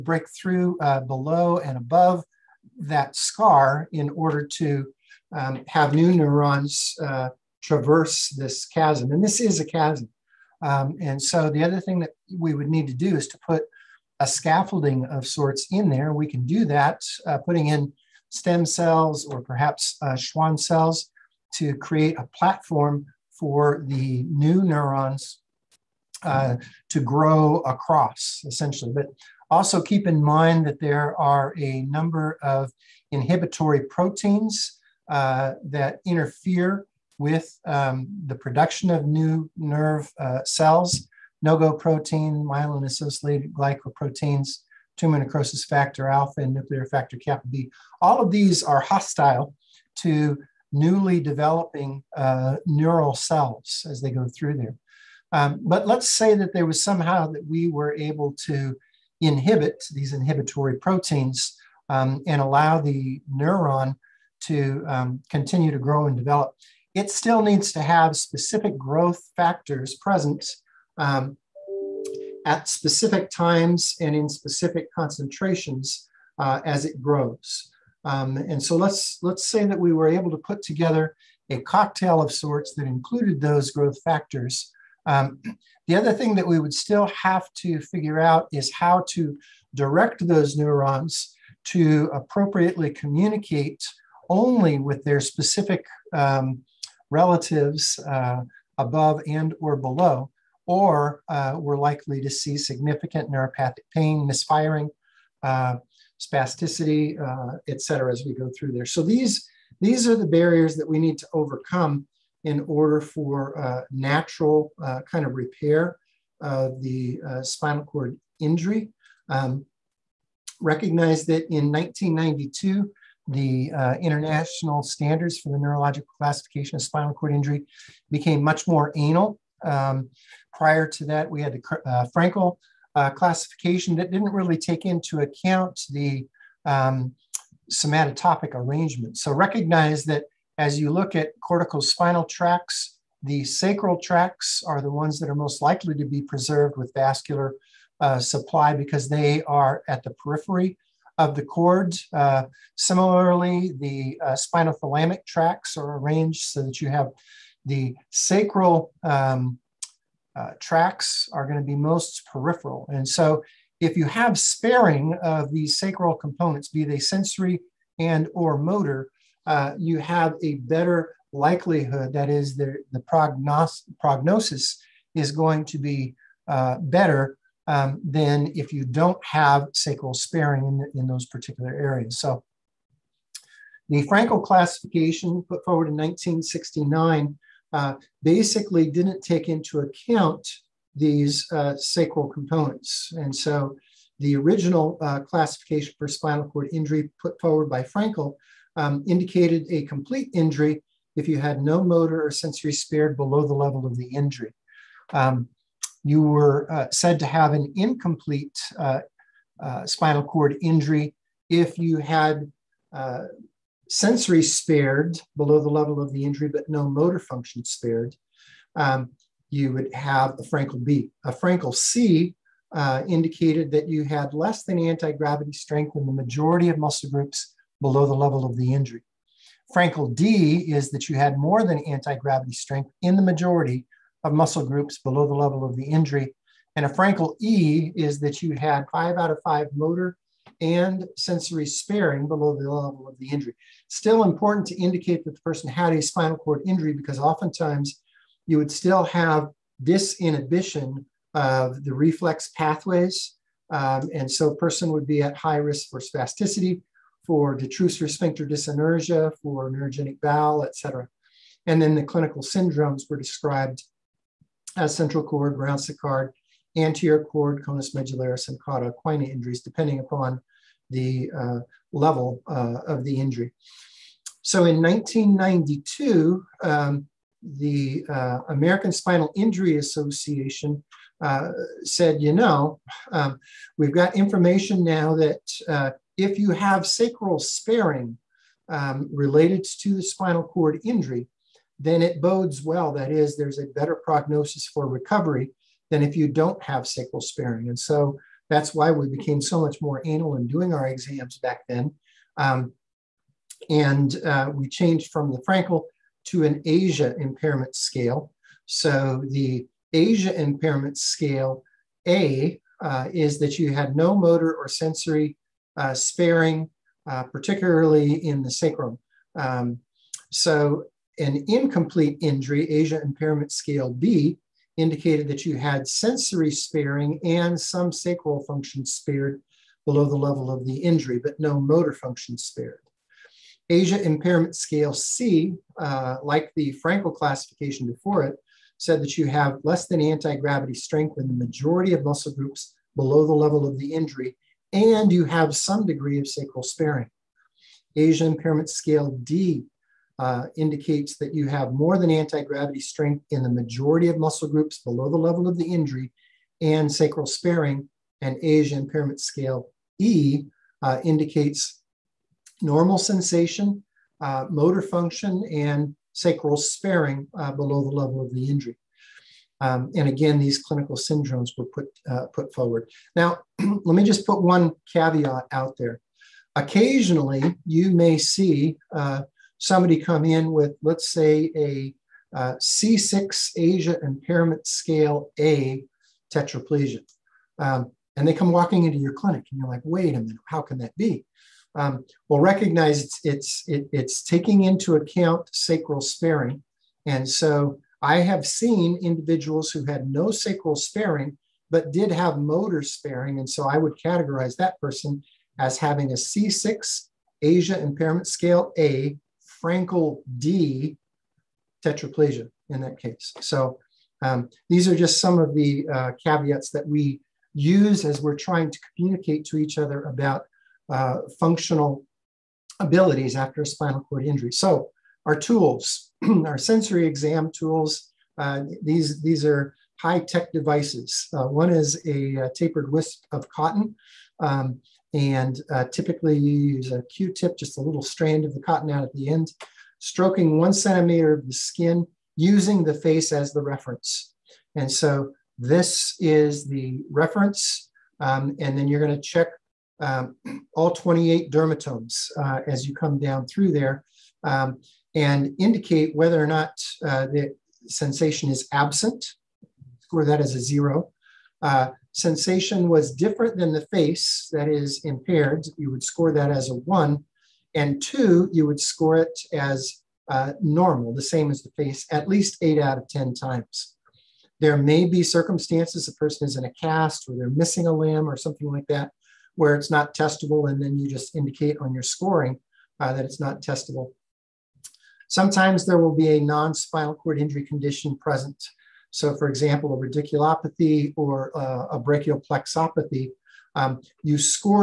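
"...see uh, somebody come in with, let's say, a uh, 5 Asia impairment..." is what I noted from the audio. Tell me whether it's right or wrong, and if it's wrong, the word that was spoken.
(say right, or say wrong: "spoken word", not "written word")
wrong: "6", not "5".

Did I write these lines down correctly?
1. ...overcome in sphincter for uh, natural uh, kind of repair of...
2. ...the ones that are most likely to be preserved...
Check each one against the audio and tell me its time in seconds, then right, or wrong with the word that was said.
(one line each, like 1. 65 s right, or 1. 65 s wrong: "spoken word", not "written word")
1. 111 s wrong: "order", not "sphincter"
2. 144 s right.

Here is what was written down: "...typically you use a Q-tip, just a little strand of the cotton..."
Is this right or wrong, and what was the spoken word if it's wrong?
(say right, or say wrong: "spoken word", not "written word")
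right.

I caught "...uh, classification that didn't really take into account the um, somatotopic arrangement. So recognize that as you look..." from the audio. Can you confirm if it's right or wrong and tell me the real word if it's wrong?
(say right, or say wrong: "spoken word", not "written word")
right.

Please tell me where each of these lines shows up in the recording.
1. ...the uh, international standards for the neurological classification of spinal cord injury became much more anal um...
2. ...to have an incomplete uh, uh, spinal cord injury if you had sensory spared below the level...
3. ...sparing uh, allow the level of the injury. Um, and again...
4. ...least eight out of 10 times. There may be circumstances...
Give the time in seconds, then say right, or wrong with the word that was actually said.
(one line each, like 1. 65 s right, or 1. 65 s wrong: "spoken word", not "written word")
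1. 123 s right
2. 207 s right
3. 366 s wrong: "below", not "allow"
4. 472 s right.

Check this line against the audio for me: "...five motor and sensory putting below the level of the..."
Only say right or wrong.
wrong.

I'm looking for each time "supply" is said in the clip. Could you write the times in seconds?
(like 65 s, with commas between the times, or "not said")
148 s.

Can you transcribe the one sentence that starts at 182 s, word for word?
So the Frankel classification put forward in 1969 uh, basically didn't take into account these uh, sacral components.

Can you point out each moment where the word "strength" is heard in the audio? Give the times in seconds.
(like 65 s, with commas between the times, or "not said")
225 s, 232 s, 340 s, 352 s.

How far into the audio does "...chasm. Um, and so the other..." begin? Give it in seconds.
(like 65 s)
9 s.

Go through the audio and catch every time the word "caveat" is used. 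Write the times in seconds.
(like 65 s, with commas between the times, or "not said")
374 s, 416 s.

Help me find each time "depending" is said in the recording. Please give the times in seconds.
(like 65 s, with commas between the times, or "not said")
269 s.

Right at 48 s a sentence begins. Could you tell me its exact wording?
All of these are hostile to newly developing uh, neural cells as they go through there.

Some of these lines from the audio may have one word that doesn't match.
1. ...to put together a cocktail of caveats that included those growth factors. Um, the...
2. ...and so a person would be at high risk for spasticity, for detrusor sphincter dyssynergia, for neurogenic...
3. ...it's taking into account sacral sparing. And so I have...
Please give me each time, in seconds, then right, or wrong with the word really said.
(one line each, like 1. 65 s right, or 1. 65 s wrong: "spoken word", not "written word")
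1. 80 s wrong: "sorts", not "caveats"
2. 254 s right
3. 393 s right.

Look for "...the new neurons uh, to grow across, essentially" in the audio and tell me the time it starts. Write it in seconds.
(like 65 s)
23 s.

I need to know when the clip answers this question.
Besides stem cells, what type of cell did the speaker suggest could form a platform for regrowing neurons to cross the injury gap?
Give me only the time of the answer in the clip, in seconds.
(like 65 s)
20 s.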